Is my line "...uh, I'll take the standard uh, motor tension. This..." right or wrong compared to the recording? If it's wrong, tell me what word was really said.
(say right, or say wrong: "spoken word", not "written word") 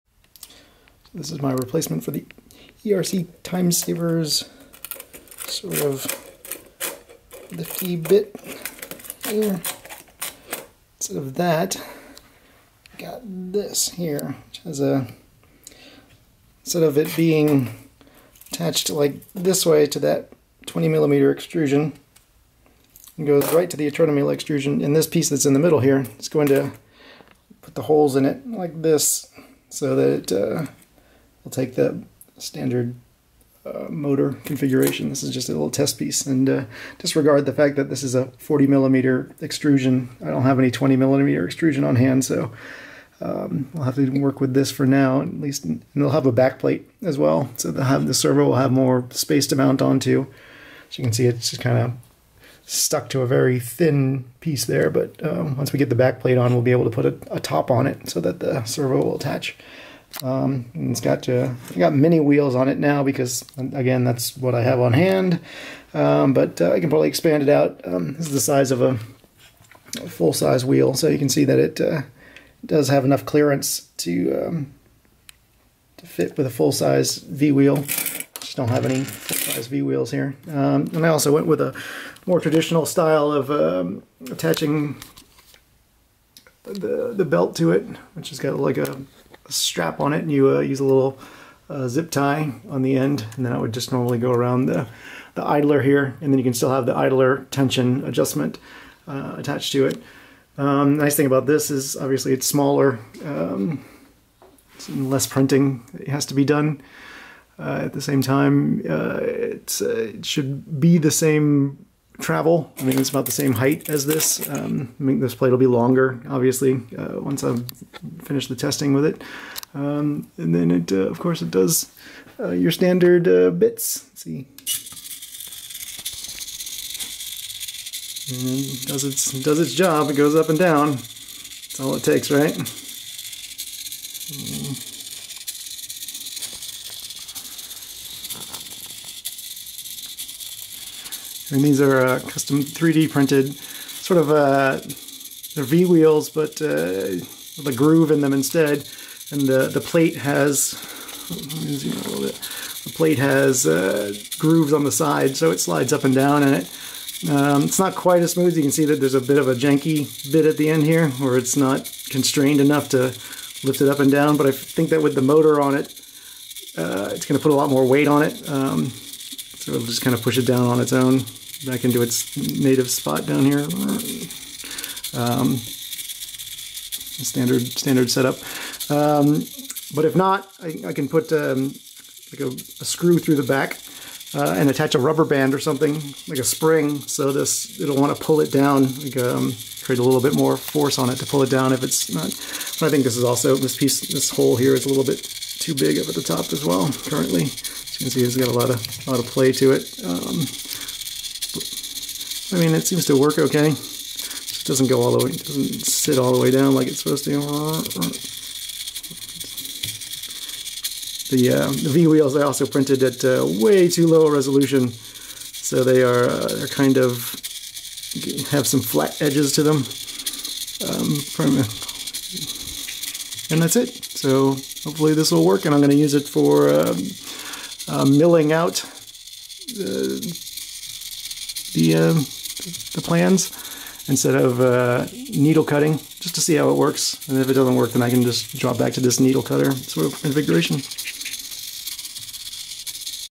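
wrong: "configuration", not "tension".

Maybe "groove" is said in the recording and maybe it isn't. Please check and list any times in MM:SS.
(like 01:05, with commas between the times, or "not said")
02:27, 02:34.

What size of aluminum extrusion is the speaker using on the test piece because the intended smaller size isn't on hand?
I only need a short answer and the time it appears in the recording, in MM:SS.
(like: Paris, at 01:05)
40 millimeter, at 00:38.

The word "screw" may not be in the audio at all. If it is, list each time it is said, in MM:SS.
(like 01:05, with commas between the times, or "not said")
03:02.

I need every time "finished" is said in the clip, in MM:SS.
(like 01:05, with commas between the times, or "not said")
01:58.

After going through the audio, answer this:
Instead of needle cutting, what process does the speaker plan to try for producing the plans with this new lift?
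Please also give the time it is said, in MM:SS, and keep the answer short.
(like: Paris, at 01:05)
milling, at 03:48.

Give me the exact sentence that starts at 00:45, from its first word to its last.
And they'll have a backplate as well, so they'll have the servo will have more space to mount onto.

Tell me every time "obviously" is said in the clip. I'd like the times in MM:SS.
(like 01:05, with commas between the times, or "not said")
01:41, 01:56.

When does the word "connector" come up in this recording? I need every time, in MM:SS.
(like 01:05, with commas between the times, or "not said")
not said.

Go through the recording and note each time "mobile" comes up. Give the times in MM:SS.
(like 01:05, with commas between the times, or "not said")
not said.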